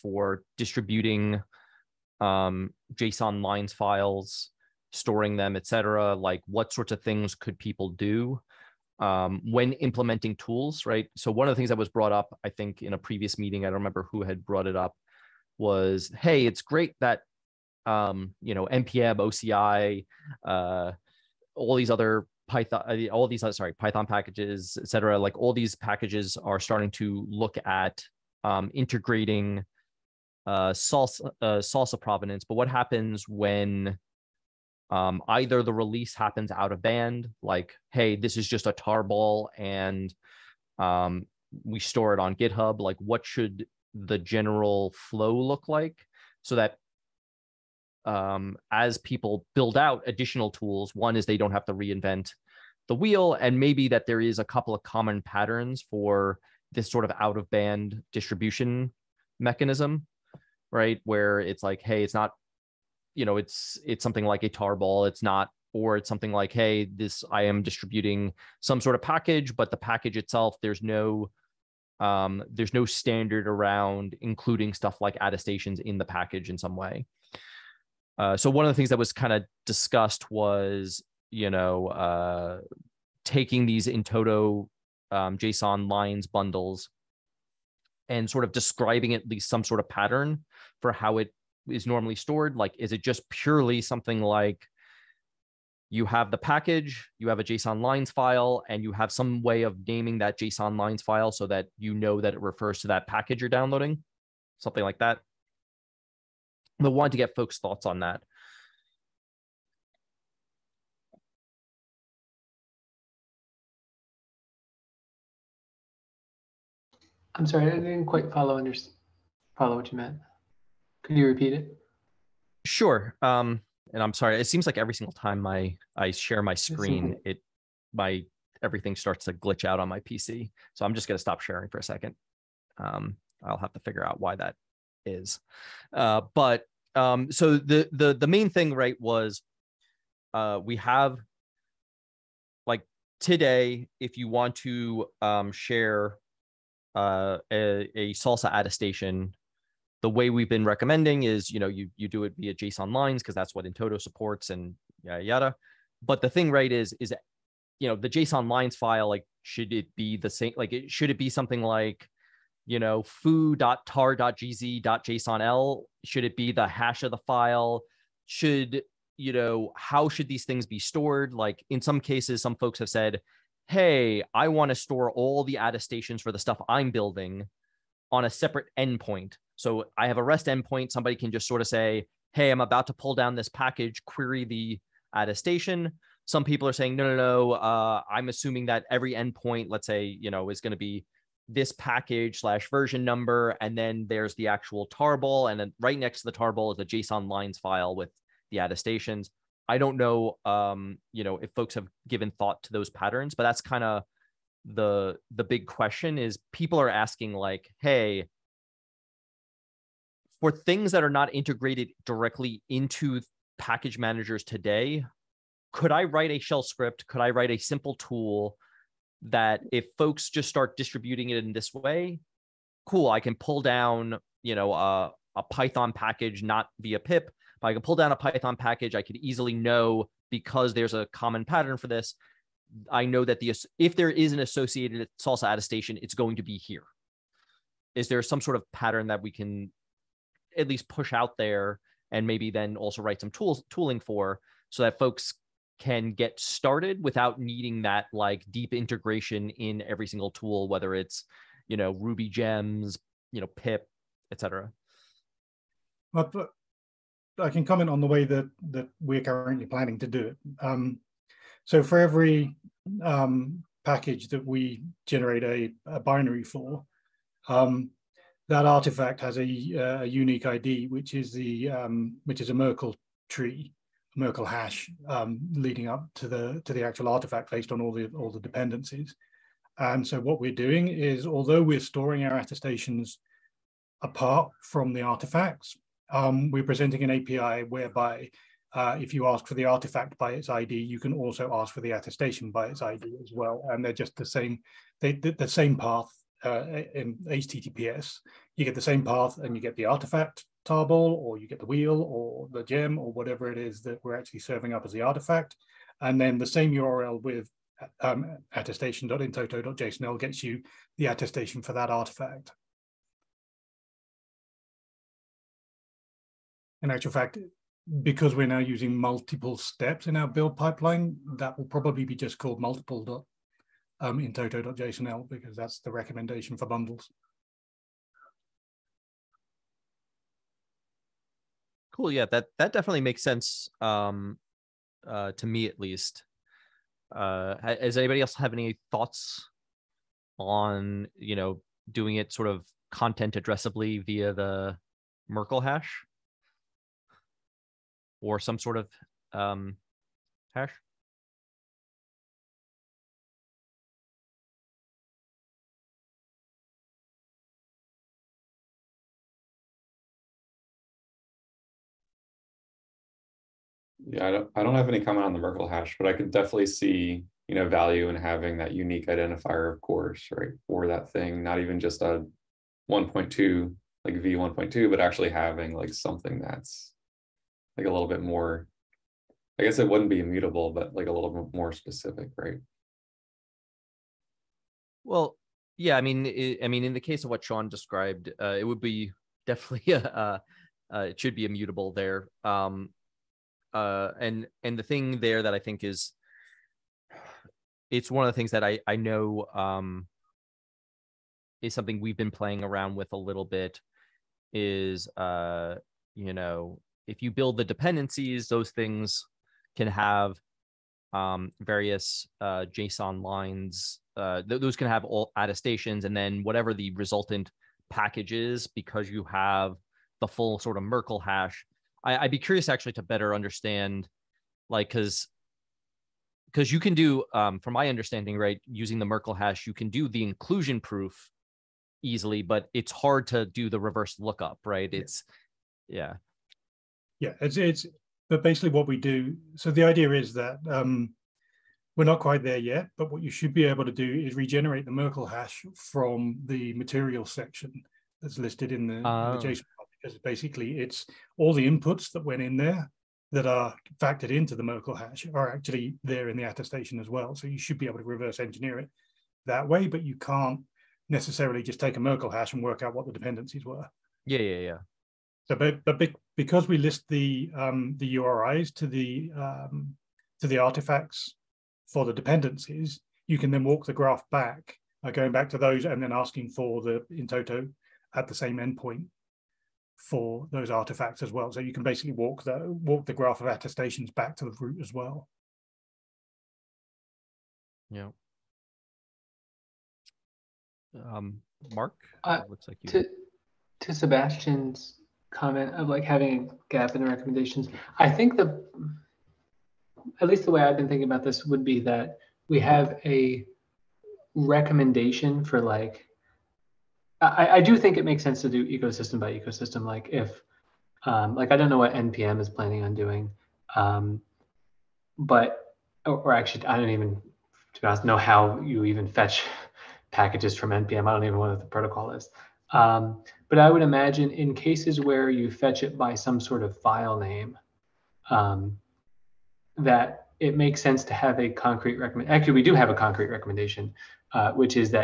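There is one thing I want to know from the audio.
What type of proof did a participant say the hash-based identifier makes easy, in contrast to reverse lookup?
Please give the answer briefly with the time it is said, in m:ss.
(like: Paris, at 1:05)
inclusion proof, at 7:10.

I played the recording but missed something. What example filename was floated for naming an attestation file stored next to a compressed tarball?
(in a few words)
foo.tar.gz.jsonl.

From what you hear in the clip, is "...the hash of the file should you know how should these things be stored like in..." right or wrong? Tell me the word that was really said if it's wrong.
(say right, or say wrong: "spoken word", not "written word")
right.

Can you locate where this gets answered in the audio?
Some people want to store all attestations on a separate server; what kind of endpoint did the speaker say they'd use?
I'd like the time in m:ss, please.
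3:00.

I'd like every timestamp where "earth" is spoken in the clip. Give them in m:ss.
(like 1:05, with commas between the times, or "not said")
not said.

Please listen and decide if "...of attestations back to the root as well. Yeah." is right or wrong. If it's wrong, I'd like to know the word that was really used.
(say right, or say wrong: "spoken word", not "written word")
right.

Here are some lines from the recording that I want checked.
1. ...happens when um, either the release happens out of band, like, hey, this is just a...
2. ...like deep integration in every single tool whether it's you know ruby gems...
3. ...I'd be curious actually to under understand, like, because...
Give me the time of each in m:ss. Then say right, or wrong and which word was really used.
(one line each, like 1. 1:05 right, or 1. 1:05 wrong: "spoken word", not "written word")
1. 0:32 right
2. 4:08 right
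3. 7:02 wrong: "better", not "under".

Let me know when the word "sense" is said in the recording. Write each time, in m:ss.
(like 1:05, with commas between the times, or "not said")
5:33, 8:28, 8:50.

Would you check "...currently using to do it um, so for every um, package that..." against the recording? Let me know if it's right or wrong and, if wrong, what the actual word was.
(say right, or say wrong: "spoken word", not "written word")
wrong: "planning", not "using".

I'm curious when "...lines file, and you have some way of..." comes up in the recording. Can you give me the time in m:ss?
1:37.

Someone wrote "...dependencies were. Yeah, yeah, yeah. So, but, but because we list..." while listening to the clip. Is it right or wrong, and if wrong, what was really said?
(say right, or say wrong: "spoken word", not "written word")
right.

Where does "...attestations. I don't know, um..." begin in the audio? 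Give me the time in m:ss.
3:18.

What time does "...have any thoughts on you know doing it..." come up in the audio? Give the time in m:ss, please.
5:38.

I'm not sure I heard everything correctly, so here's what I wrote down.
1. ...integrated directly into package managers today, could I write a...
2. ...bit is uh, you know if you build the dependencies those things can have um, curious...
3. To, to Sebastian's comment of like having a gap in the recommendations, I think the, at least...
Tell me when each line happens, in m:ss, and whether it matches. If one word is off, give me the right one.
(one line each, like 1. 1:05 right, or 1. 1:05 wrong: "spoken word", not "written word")
1. 3:31 right
2. 6:43 wrong: "various", not "curious"
3. 8:12 right.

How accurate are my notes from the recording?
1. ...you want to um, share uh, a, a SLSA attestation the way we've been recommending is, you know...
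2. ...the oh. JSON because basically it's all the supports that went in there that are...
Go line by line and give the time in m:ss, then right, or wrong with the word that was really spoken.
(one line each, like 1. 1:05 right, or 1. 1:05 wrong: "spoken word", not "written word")
1. 2:24 right
2. 7:28 wrong: "inputs", not "supports".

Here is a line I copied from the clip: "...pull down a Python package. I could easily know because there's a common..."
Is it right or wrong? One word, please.
right.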